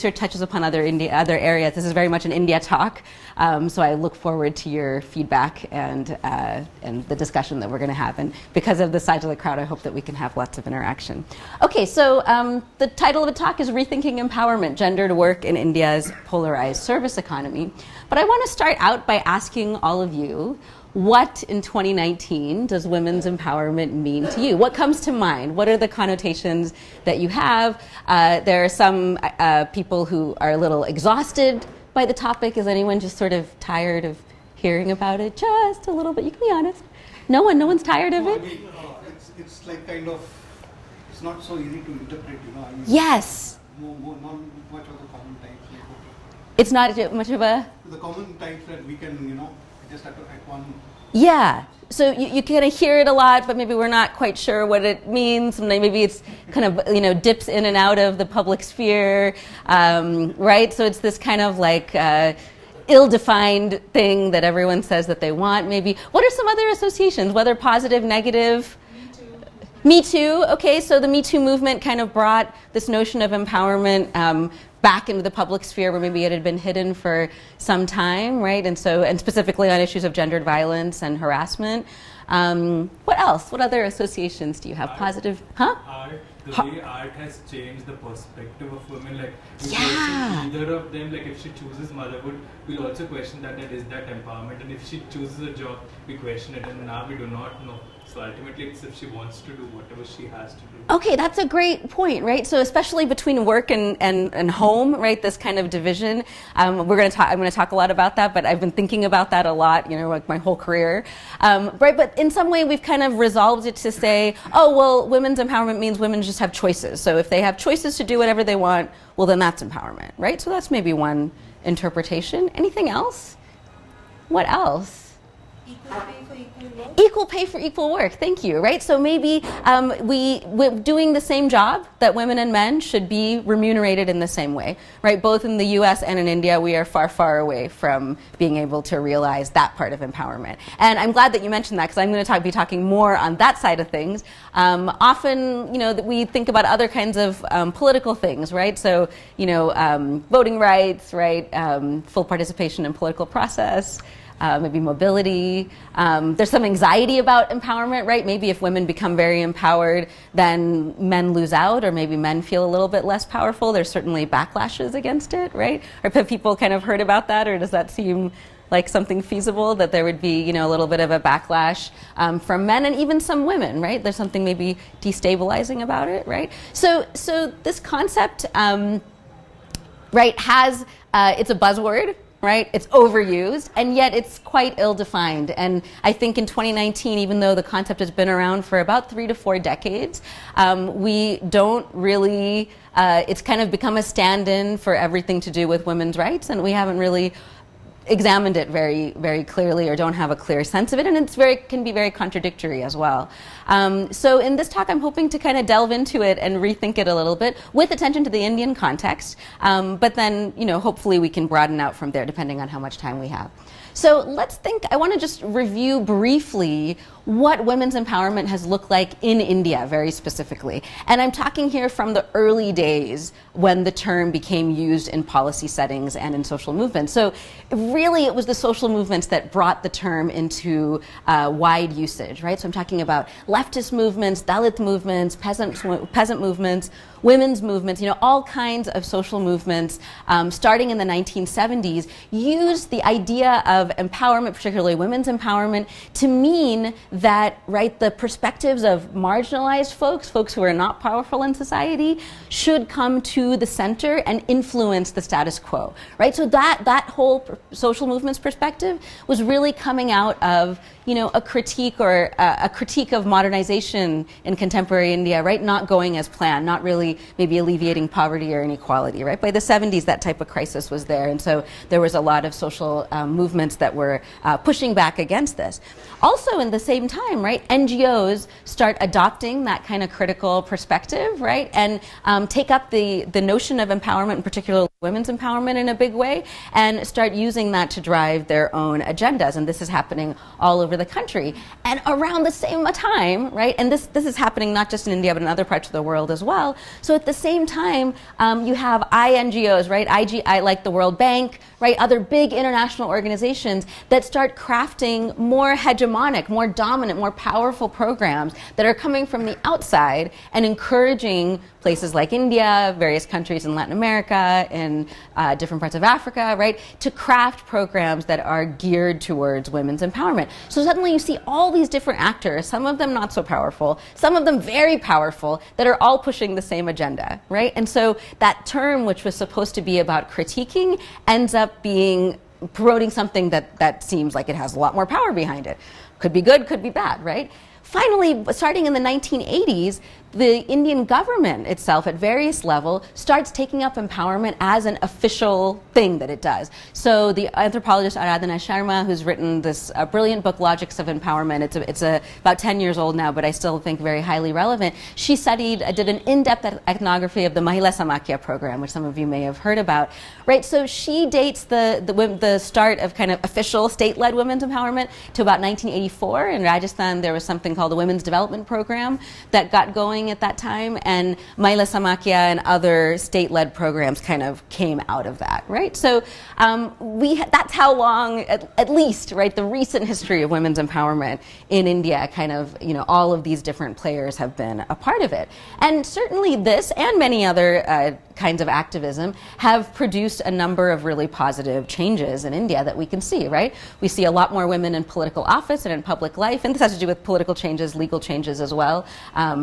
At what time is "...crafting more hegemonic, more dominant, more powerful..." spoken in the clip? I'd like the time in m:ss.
5:04.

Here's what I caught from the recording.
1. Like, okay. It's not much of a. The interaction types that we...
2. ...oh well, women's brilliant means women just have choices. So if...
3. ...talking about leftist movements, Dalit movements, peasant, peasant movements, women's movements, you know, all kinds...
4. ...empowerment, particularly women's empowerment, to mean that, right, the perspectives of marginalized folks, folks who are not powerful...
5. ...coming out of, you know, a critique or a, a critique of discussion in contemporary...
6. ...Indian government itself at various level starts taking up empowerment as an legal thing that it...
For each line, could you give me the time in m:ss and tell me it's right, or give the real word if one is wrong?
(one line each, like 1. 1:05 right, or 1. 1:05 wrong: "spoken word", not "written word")
1. 0:45 wrong: "common", not "interaction"
2. 1:54 wrong: "empowerment", not "brilliant"
3. 3:52 right
4. 4:03 right
5. 4:19 wrong: "modernization", not "discussion"
6. 5:40 wrong: "official", not "legal".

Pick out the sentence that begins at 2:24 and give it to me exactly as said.
Um, often, you know, that we think about other kinds of um, political things.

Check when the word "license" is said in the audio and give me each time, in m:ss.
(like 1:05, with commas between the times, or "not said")
not said.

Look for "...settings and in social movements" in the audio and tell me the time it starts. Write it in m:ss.
3:45.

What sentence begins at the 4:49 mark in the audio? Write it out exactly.
And this is happening all over over the country.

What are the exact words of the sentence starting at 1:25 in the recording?
Art, the ha way art has changed the perspective of women.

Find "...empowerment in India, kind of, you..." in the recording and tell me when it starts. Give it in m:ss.
6:20.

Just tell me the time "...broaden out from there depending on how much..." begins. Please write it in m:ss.
3:31.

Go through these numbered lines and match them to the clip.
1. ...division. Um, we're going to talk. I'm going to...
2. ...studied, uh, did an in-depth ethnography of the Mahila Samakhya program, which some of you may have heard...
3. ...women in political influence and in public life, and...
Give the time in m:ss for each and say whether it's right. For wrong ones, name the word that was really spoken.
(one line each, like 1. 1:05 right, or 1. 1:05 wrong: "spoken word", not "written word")
1. 1:45 right
2. 5:55 right
3. 6:34 wrong: "office", not "influence".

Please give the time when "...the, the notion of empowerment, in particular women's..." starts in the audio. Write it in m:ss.
4:42.